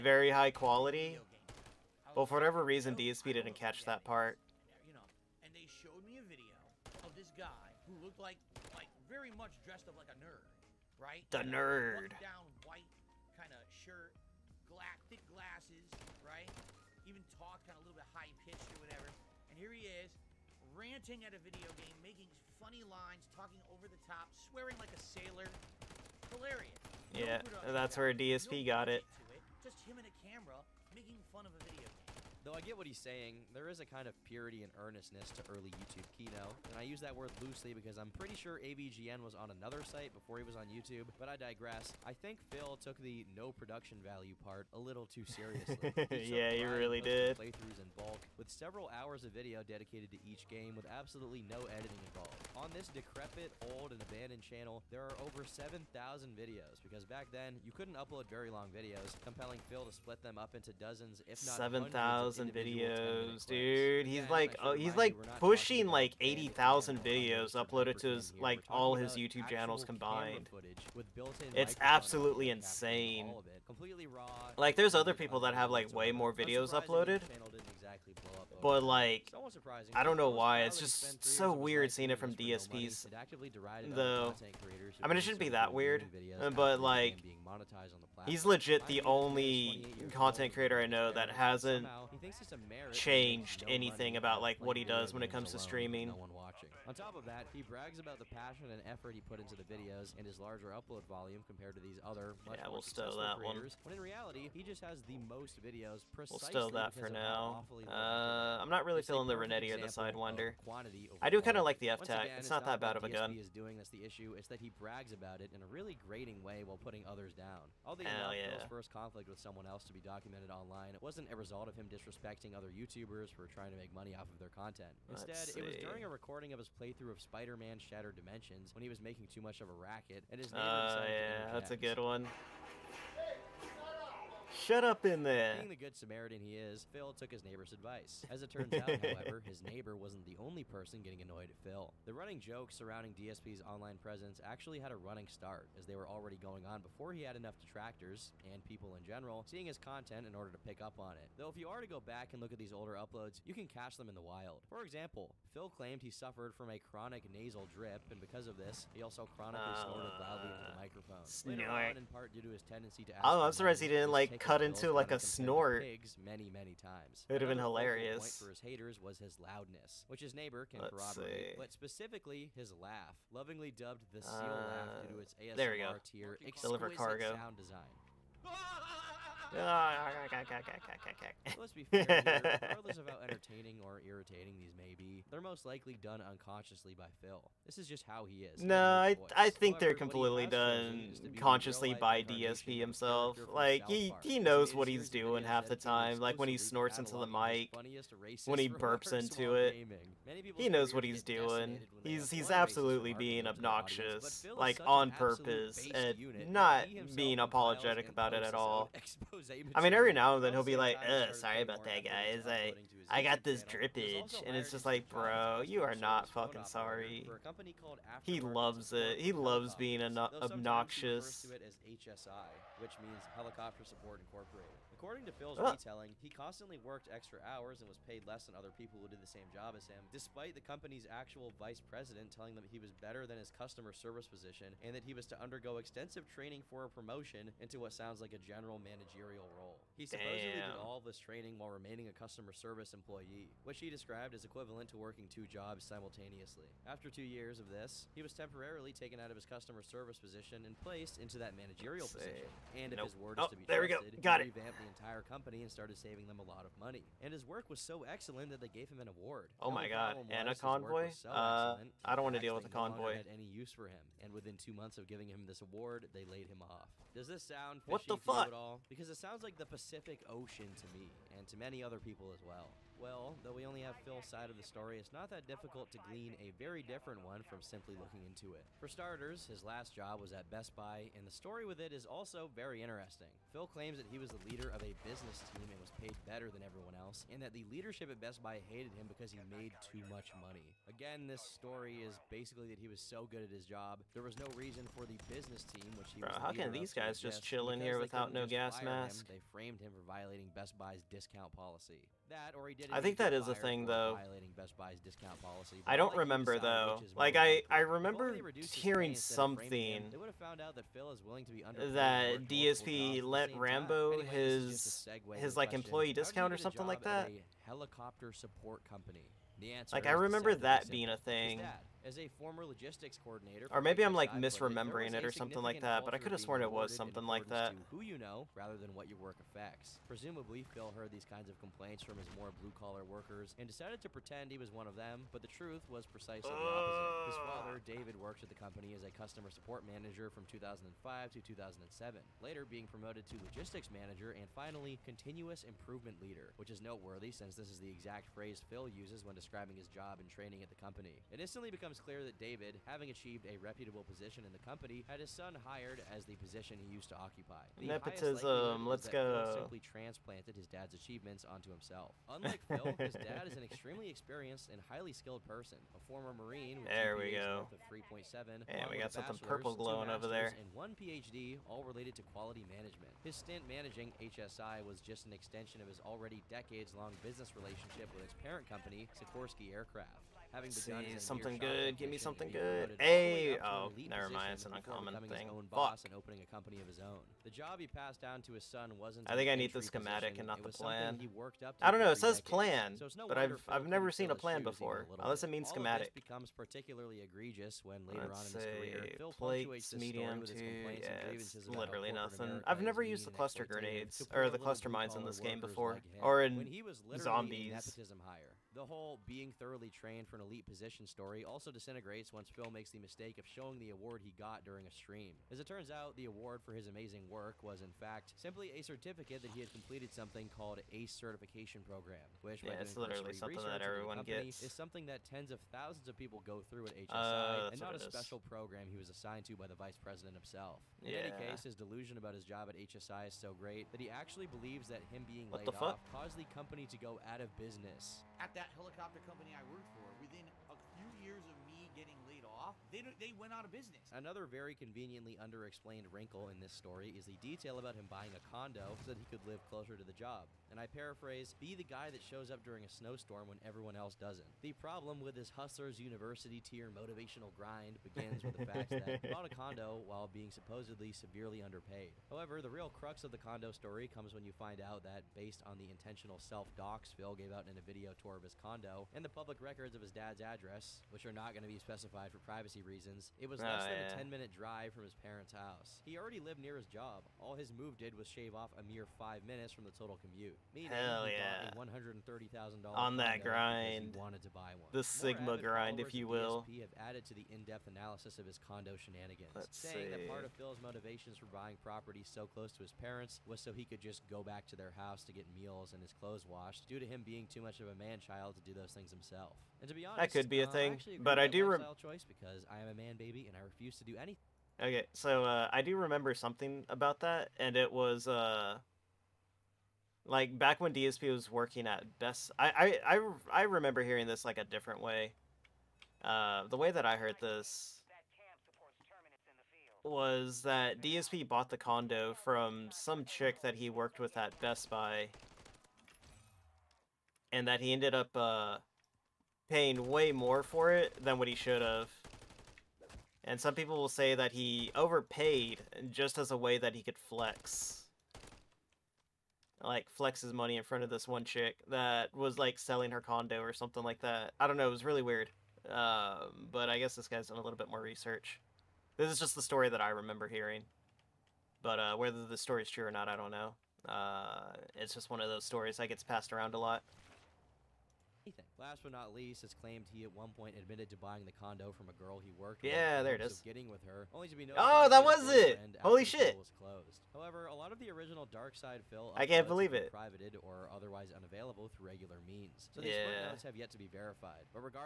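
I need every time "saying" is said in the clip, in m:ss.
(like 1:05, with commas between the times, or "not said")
0:32, 8:09.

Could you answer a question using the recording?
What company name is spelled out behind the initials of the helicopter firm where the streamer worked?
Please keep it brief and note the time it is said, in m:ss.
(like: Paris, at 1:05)
Helicopter Support Incorporated, at 3:43.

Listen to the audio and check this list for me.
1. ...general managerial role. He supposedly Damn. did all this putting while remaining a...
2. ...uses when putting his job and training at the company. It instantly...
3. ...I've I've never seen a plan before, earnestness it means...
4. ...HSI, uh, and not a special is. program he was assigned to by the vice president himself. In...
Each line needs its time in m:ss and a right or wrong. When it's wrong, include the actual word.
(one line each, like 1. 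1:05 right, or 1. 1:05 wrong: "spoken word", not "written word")
1. 3:58 wrong: "training", not "putting"
2. 5:48 wrong: "describing", not "putting"
3. 6:33 wrong: "unless", not "earnestness"
4. 7:06 right.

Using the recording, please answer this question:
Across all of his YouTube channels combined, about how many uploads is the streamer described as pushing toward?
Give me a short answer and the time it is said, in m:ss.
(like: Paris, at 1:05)
80,000, at 1:06.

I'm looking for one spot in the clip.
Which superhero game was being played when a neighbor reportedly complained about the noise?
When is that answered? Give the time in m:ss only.
2:07.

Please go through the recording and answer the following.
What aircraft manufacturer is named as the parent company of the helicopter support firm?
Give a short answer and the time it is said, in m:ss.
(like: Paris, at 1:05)
Sikorsky Aircraft, at 6:19.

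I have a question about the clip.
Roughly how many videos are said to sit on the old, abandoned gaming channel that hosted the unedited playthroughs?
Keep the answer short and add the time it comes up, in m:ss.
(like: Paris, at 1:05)
7,000, at 0:55.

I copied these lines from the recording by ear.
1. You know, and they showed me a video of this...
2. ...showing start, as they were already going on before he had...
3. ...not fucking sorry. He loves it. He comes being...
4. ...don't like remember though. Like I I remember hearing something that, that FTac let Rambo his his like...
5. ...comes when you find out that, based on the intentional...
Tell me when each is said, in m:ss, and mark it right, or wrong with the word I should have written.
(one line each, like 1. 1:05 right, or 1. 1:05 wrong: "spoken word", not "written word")
1. 0:04 right
2. 2:24 wrong: "running", not "showing"
3. 3:35 wrong: "loves", not "comes"
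4. 5:05 wrong: "DSP", not "FTac"
5. 7:44 right.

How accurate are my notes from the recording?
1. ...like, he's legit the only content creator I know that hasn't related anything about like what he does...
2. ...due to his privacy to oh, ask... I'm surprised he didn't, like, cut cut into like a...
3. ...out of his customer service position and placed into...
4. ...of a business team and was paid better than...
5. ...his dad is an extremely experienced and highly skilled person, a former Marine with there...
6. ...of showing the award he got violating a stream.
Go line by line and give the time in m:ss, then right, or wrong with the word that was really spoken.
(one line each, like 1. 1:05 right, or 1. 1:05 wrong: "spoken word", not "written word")
1. 1:26 wrong: "changed", not "related"
2. 2:42 wrong: "tendency", not "privacy"
3. 4:09 right
4. 4:44 right
5. 6:02 right
6. 6:53 wrong: "during", not "violating".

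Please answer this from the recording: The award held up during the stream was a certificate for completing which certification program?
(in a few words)
ACE certification program.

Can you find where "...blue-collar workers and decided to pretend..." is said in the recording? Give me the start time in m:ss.
5:32.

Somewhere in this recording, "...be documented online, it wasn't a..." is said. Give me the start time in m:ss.
1:59.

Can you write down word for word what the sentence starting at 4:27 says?
Does this sound fishy what the fuck?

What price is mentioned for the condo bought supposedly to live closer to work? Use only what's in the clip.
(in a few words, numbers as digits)
$130,000.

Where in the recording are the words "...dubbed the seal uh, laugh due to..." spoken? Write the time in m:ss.
2:53.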